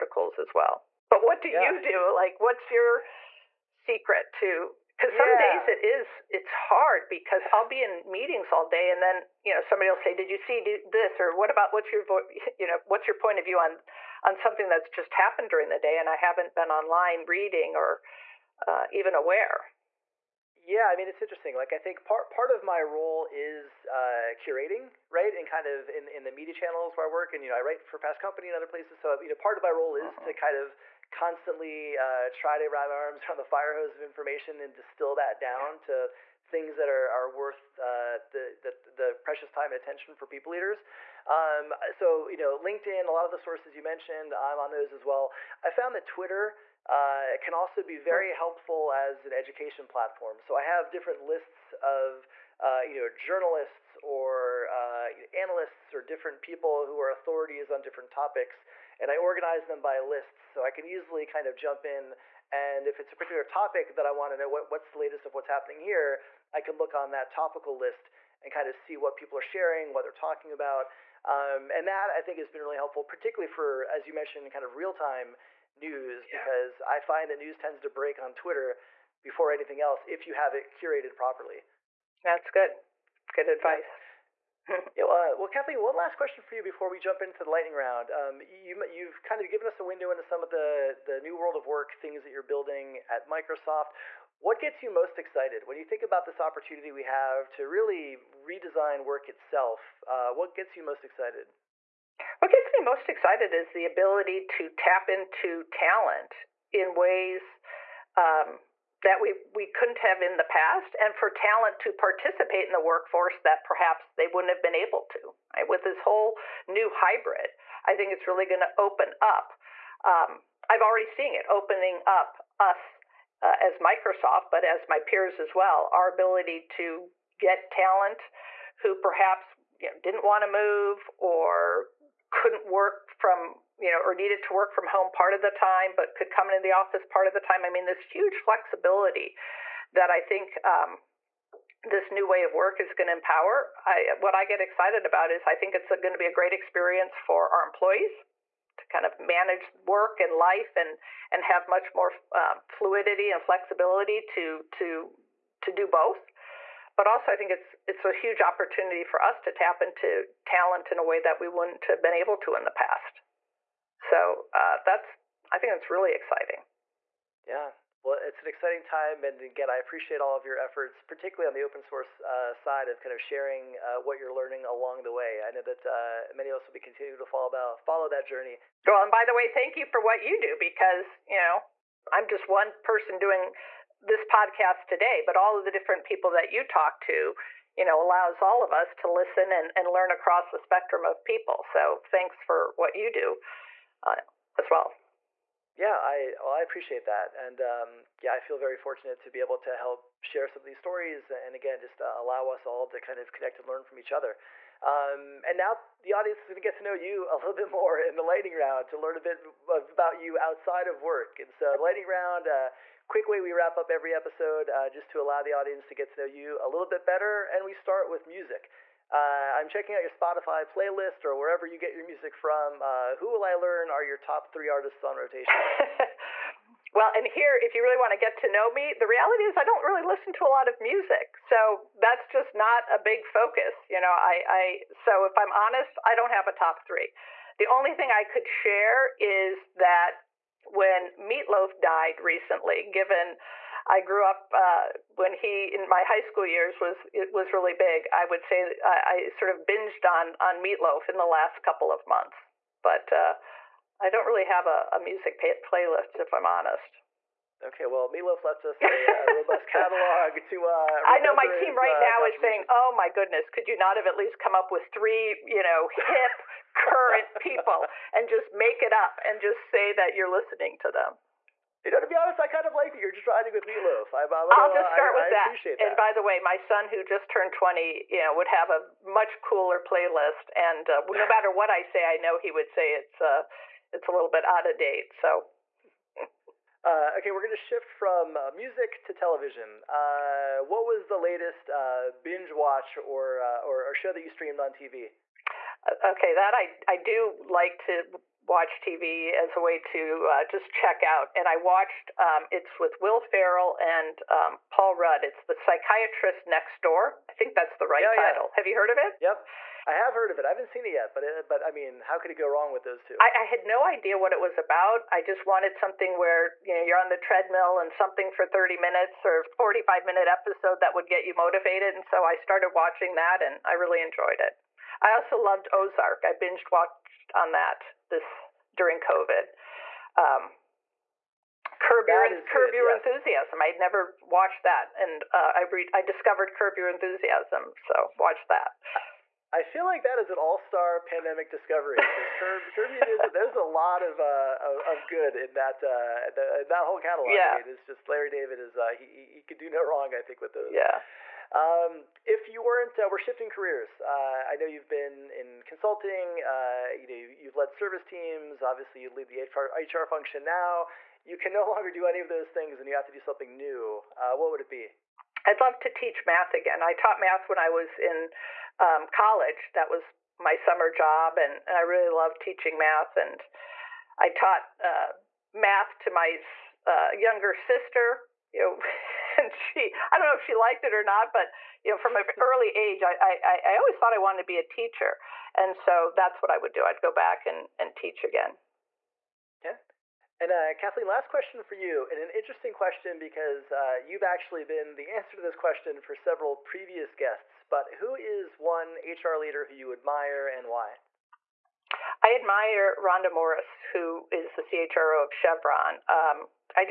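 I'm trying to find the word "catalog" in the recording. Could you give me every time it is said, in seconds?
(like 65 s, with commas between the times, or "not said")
259 s, 346 s.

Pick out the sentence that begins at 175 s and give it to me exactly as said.
I know that uh, many of us will be continuing to follow that, follow that journey.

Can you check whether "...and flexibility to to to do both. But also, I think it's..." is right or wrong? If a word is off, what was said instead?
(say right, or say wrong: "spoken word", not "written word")
right.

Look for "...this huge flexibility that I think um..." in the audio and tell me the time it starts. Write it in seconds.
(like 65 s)
137 s.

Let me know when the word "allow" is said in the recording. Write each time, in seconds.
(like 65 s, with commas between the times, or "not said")
187 s, 202 s, 215 s.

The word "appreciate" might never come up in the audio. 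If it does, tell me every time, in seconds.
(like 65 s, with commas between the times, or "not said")
169 s, 196 s, 275 s.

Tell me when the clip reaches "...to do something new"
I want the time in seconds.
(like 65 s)
363 s.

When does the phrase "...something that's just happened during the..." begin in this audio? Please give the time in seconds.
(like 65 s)
14 s.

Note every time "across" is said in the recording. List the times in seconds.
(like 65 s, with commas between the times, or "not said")
190 s.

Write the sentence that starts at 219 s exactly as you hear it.
Uh, I'm checking out your Spotify playlist or wherever you get your music from.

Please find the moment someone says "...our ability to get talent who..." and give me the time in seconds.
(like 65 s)
125 s.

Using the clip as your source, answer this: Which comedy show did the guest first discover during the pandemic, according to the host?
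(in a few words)
Curb Your Enthusiasm.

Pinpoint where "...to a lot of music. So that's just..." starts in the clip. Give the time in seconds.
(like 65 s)
230 s.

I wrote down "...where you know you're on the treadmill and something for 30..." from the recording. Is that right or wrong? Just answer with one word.
right.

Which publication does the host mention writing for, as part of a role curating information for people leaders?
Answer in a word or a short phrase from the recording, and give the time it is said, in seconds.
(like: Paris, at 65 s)
Fast Company, at 27 s.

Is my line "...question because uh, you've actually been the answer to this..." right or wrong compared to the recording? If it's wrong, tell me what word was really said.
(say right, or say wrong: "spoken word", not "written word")
right.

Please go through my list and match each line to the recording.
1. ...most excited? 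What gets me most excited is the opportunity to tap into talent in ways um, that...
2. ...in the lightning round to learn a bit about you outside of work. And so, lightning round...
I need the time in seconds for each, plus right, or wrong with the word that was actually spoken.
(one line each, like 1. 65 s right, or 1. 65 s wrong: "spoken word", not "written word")
1. 100 s wrong: "ability", not "opportunity"
2. 207 s right.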